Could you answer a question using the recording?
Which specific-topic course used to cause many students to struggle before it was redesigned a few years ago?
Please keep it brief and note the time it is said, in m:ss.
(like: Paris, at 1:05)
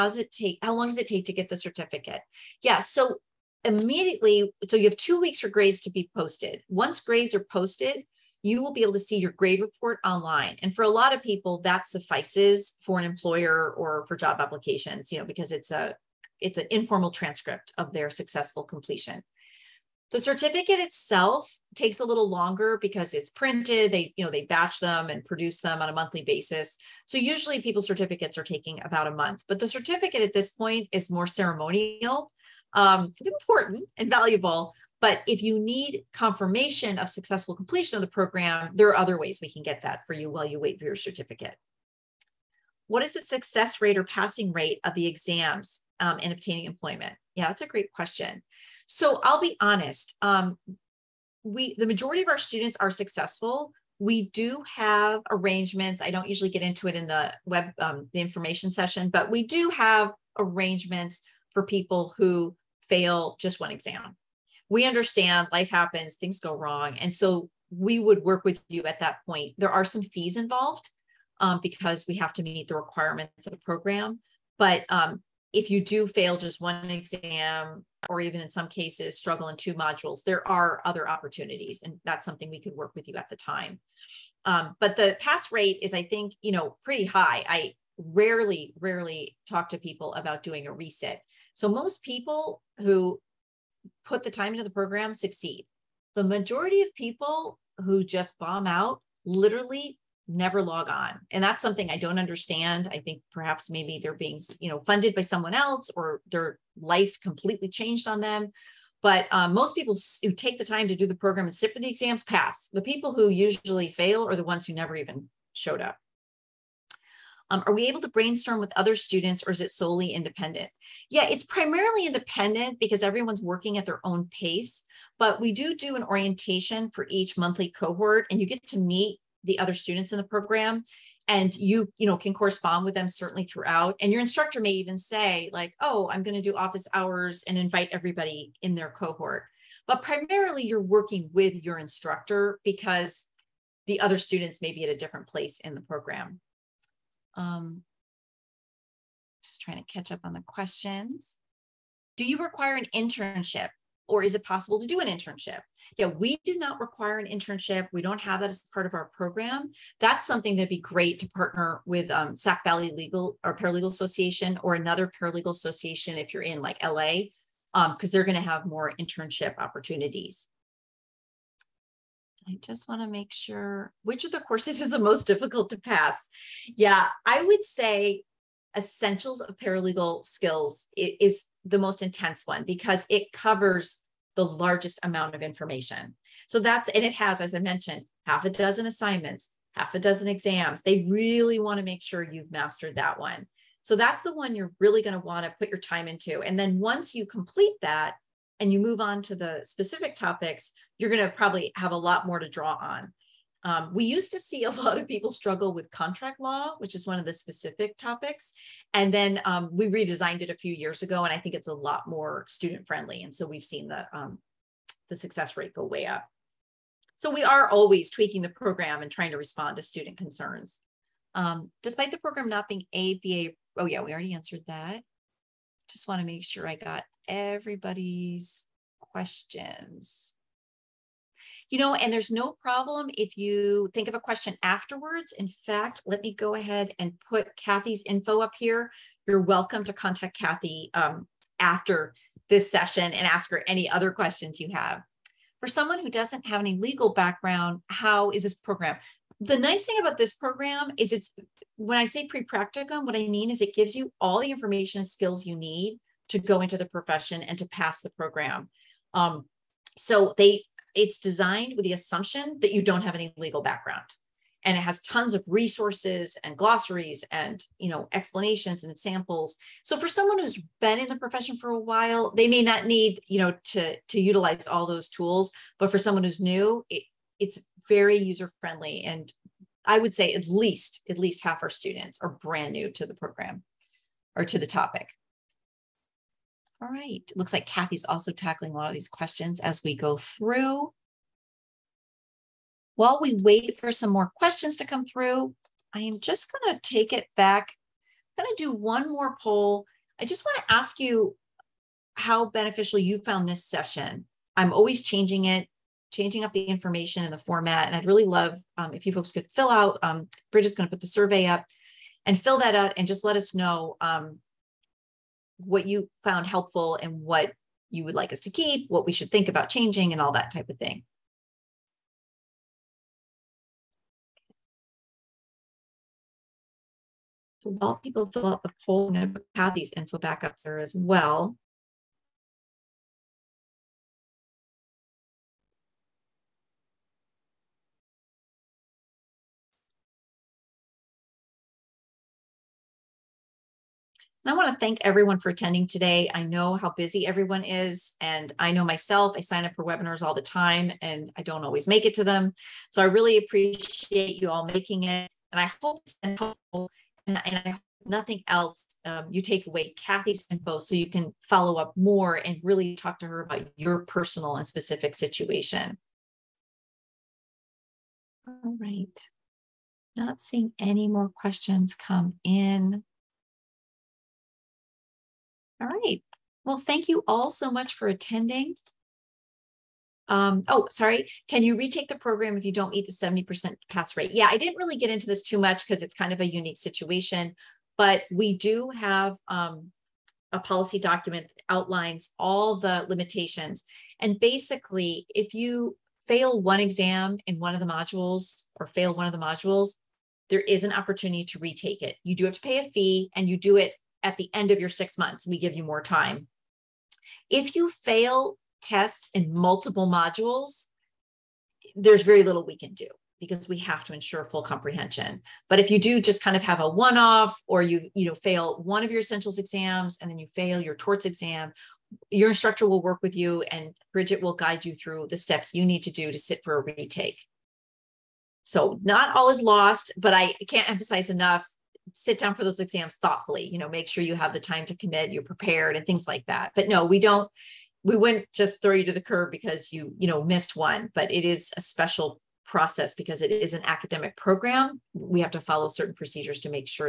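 Contract law, at 3:25.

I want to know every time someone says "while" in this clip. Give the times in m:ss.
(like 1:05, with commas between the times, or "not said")
0:40, 4:31, 4:52, 5:27.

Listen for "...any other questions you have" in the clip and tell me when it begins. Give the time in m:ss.
4:03.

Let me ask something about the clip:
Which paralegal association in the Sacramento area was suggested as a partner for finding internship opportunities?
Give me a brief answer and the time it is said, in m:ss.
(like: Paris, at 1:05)
Sac Valley Legal, at 2:42.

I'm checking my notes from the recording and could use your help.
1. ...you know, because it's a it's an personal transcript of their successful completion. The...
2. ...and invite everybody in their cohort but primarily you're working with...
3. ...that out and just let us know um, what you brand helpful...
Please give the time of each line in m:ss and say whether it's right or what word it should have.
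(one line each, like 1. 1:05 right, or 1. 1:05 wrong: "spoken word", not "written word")
1. 0:15 wrong: "informal", not "personal"
2. 2:17 right
3. 5:12 wrong: "found", not "brand".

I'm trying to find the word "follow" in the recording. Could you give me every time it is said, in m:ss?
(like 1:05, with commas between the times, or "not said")
6:01, 7:25.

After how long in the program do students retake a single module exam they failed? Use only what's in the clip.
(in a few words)
six months.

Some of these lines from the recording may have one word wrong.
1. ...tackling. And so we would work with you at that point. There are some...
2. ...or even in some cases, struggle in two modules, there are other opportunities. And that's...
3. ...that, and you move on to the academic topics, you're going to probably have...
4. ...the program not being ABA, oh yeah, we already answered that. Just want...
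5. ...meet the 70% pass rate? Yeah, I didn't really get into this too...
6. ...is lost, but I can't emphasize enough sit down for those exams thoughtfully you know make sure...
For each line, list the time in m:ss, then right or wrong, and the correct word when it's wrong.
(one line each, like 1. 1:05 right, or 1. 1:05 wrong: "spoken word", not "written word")
1. 1:06 wrong: "wrong", not "tackling"
2. 1:18 right
3. 3:17 wrong: "specific", not "academic"
4. 3:42 right
5. 6:22 right
6. 7:09 right.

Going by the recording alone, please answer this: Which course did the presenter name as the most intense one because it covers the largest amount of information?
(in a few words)
Essentials of Paralegal Skills.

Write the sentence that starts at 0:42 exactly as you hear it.
What is the success rate or passing rate of the exams um, in obtaining employment?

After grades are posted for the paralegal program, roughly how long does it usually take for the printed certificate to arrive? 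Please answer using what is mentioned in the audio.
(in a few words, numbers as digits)
about a month.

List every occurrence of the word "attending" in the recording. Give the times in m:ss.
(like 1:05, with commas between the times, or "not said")
5:45, 6:18.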